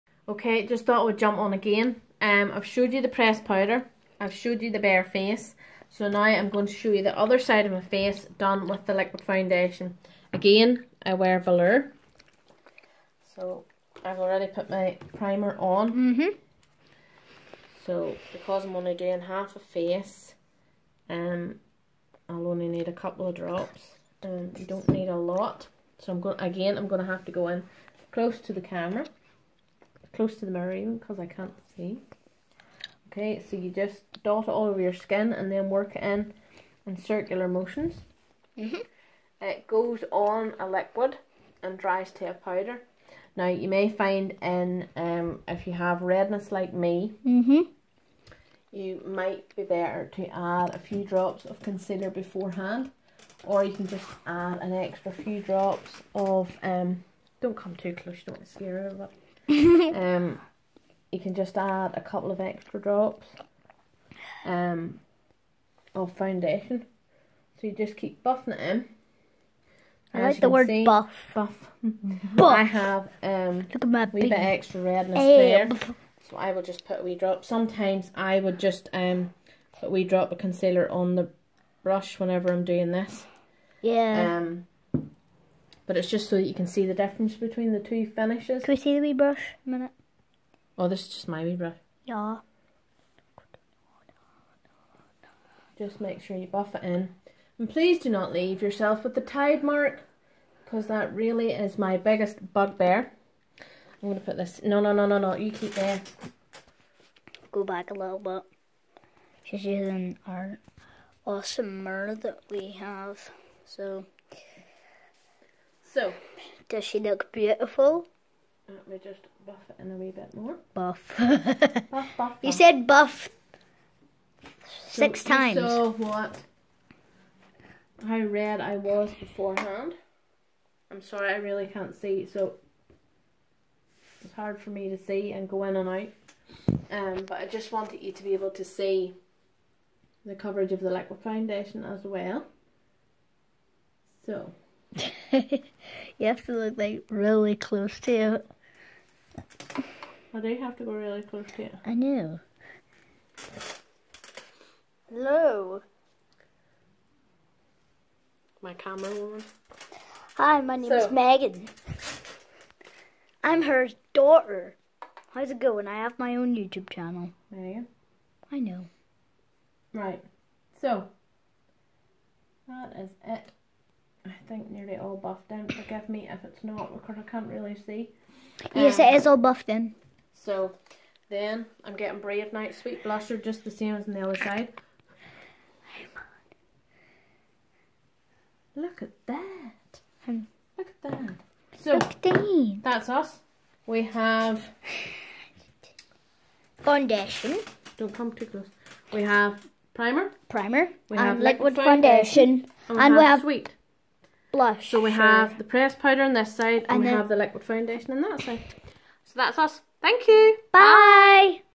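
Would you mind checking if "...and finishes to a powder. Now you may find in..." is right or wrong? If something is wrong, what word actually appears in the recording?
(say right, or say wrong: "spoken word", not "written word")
wrong: "dries", not "finishes".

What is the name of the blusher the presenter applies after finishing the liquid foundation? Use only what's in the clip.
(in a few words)
Brave Night Sweet Blusher.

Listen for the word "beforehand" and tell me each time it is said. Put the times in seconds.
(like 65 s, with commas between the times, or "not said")
52 s, 129 s.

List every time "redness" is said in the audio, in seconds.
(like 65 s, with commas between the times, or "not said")
46 s, 74 s.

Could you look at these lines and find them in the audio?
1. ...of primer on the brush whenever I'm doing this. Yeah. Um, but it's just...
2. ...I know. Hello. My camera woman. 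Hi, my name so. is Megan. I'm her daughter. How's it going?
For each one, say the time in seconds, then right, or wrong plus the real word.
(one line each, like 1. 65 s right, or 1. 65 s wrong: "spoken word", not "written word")
1. 80 s wrong: "concealer", not "primer"
2. 151 s right.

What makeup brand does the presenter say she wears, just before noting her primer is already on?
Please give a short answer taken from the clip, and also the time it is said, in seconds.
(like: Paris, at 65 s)
Velour, at 11 s.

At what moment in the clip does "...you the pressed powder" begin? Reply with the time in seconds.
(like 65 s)
2 s.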